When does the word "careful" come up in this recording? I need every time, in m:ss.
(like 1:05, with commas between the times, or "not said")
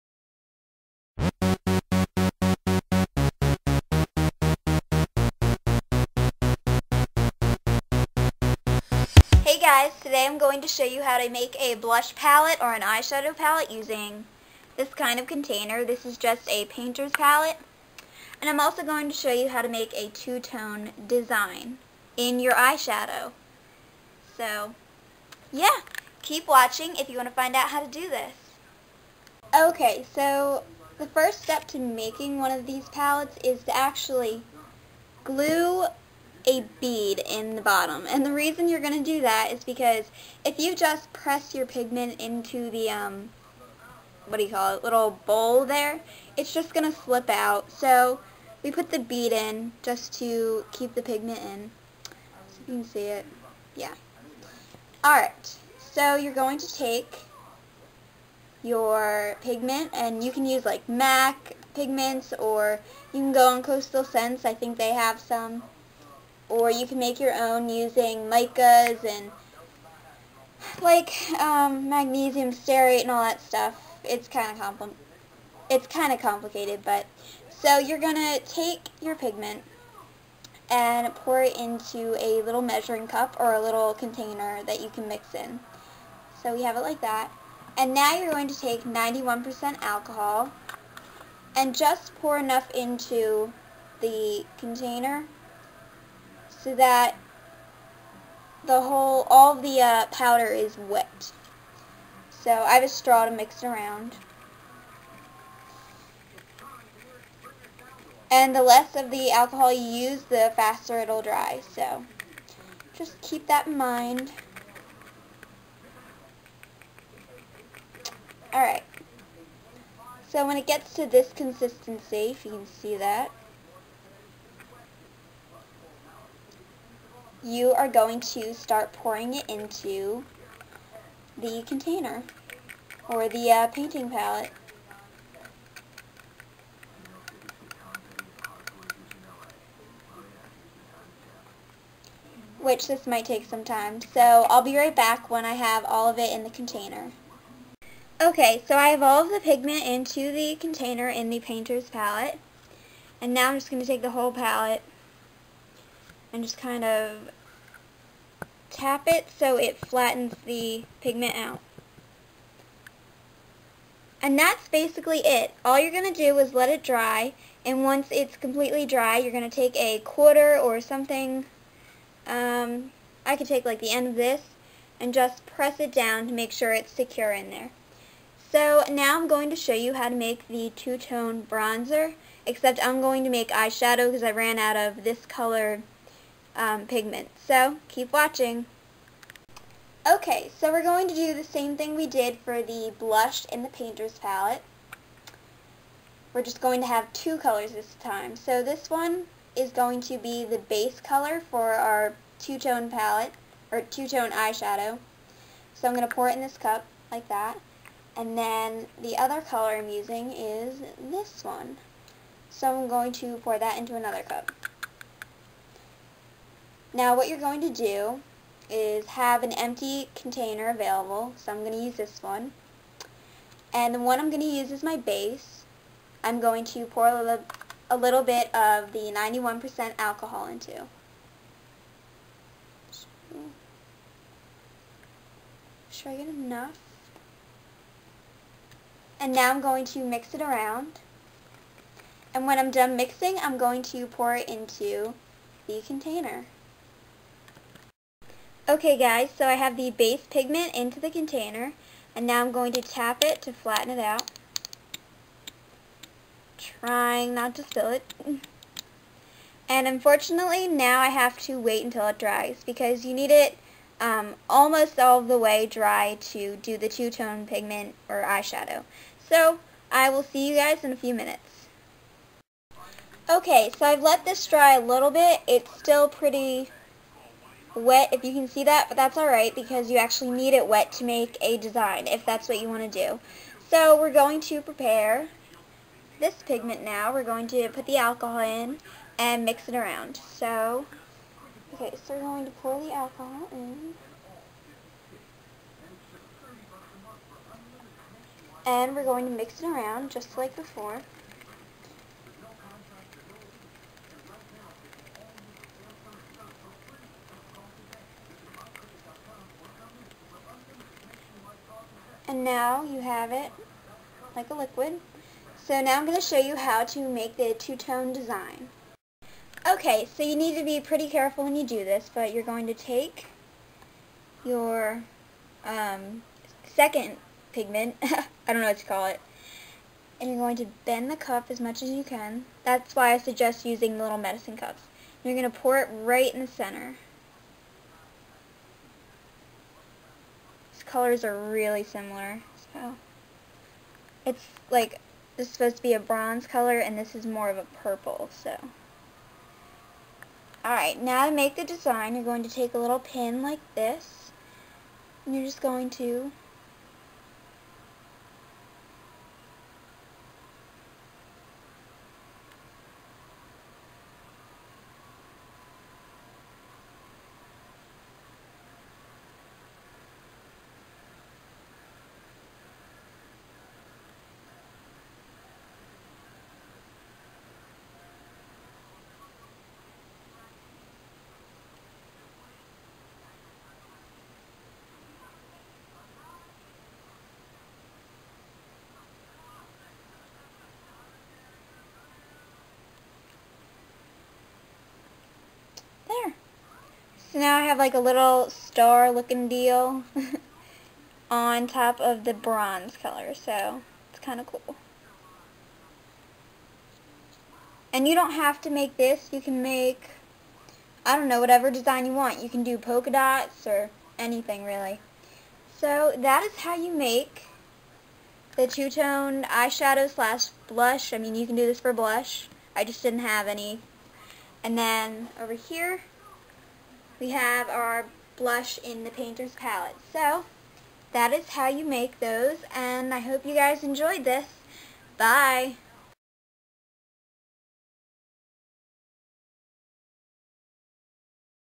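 5:21.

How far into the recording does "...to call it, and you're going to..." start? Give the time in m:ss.
5:28.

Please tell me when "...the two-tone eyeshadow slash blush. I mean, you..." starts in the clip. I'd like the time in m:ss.
6:58.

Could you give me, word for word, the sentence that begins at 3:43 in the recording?
And the one I'm going to use is my base.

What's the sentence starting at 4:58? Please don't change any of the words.
And we're going to mix it around just like before.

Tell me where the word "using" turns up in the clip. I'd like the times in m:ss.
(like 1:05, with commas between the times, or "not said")
0:13, 1:07, 3:29, 5:33.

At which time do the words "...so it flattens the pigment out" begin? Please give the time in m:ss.
2:39.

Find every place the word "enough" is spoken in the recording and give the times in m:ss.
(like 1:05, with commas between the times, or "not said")
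1:32, 3:56.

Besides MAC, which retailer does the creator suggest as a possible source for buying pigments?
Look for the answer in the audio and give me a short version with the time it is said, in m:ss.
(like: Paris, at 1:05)
Coastal Scents, at 1:03.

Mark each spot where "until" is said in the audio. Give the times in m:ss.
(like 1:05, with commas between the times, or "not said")
4:21.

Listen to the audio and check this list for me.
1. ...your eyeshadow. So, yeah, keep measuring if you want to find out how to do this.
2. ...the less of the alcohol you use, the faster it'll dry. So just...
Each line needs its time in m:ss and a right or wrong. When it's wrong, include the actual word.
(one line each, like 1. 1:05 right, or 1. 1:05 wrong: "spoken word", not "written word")
1. 0:22 wrong: "watching", not "measuring"
2. 1:48 right.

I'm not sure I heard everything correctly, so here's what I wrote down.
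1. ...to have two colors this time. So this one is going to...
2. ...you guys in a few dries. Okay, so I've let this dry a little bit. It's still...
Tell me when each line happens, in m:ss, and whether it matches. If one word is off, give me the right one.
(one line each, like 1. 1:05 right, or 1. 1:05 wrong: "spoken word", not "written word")
1. 3:16 right
2. 4:30 wrong: "minutes", not "dries".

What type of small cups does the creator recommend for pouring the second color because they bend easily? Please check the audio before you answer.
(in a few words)
medicine cups.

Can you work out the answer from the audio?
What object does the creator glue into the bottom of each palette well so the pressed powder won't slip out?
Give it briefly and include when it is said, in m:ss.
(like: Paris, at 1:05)
a bead, at 0:36.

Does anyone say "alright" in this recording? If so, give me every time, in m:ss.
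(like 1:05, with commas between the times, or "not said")
0:55, 1:58, 4:39, 5:50.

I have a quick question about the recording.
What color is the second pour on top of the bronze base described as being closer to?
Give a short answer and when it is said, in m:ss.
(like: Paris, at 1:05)
purple, at 5:47.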